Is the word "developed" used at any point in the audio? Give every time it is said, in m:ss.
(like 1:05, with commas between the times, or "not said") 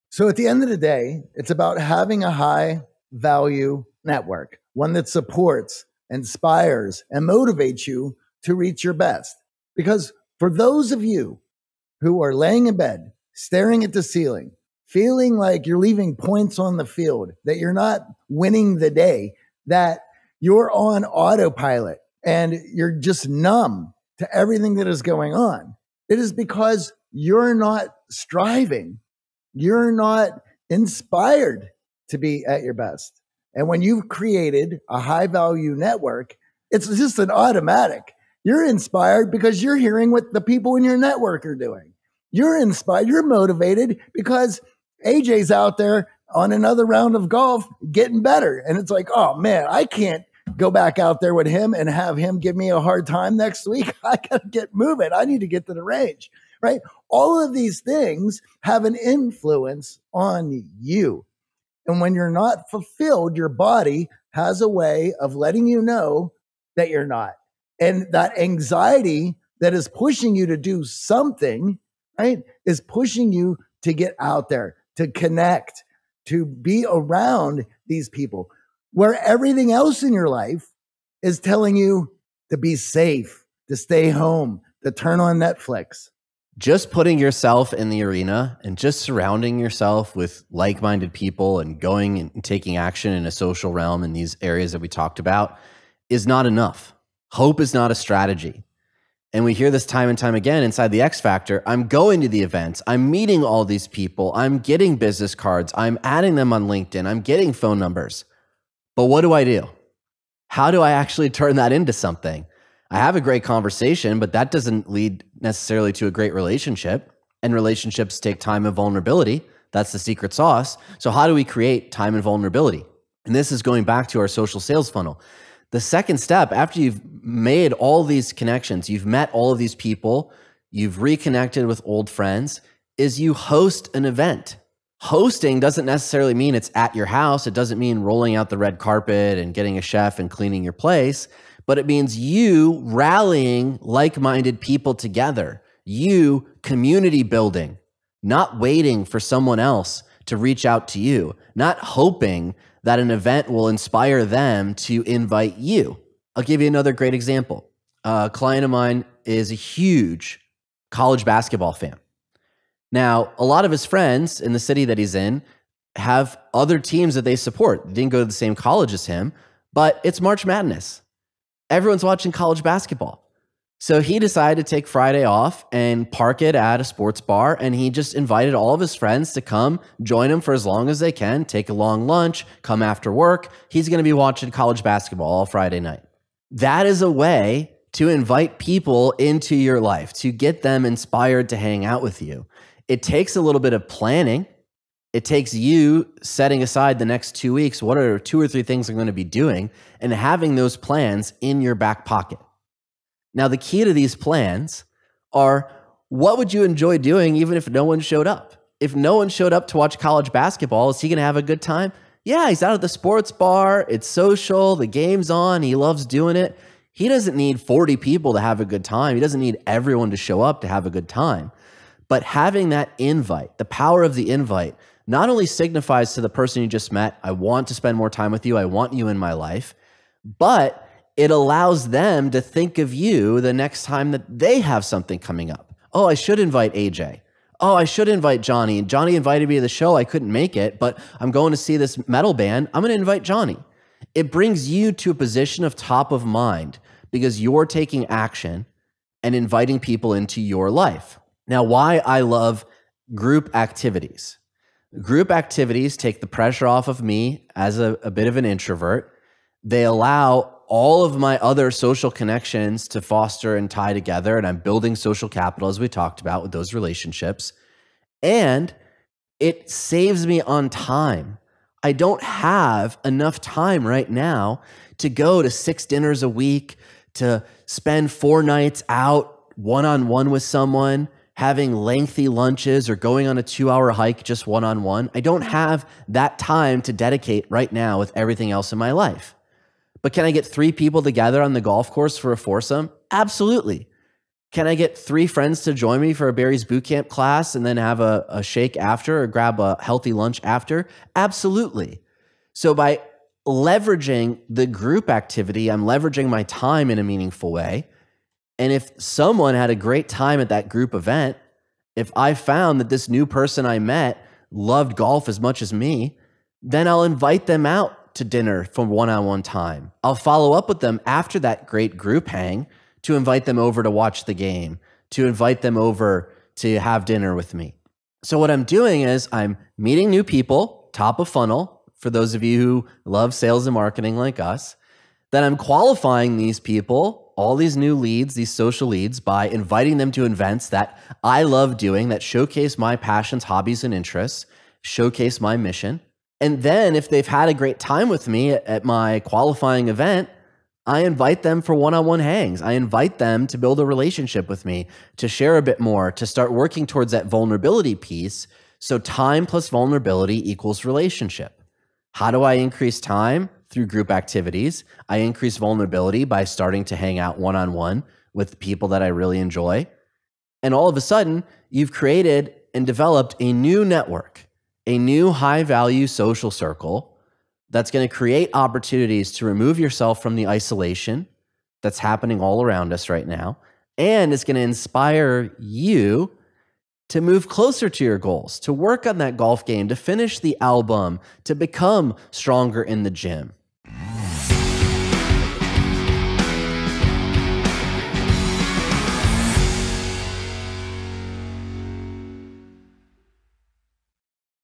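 6:12.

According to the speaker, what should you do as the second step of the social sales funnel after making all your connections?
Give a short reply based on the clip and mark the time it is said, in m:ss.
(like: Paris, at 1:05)
Host an event, at 2:13.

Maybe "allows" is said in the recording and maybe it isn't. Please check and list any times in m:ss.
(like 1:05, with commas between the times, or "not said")
3:51, 4:19.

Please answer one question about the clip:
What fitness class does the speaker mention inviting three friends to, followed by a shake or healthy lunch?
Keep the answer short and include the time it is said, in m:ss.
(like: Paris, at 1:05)
Barry's Bootcamp, at 4:56.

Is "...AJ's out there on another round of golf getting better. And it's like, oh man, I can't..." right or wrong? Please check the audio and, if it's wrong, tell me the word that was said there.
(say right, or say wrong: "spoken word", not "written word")
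right.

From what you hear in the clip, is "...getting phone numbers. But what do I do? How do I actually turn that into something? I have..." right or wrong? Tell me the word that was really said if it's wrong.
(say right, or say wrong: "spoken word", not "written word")
right.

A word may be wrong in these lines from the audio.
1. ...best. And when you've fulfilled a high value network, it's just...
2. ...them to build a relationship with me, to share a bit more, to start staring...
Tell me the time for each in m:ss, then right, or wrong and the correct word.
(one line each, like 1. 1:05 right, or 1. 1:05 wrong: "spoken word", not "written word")
1. 0:32 wrong: "created", not "fulfilled"
2. 5:53 wrong: "working", not "staring".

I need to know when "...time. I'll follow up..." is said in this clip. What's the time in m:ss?
5:19.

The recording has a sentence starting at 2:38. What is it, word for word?
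A client of mine is a huge college basketball fan.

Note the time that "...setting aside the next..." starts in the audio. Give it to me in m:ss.
3:16.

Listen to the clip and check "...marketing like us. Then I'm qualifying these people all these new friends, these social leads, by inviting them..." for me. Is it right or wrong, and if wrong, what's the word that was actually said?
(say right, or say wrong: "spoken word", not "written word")
wrong: "leads", not "friends".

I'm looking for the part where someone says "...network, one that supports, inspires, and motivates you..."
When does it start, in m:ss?
0:04.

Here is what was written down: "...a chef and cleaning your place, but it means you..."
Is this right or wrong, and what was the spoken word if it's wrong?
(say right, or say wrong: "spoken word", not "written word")
right.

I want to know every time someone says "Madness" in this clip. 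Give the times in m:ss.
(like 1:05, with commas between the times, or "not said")
2:50.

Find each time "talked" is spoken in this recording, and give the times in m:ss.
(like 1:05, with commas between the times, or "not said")
1:34, 4:25.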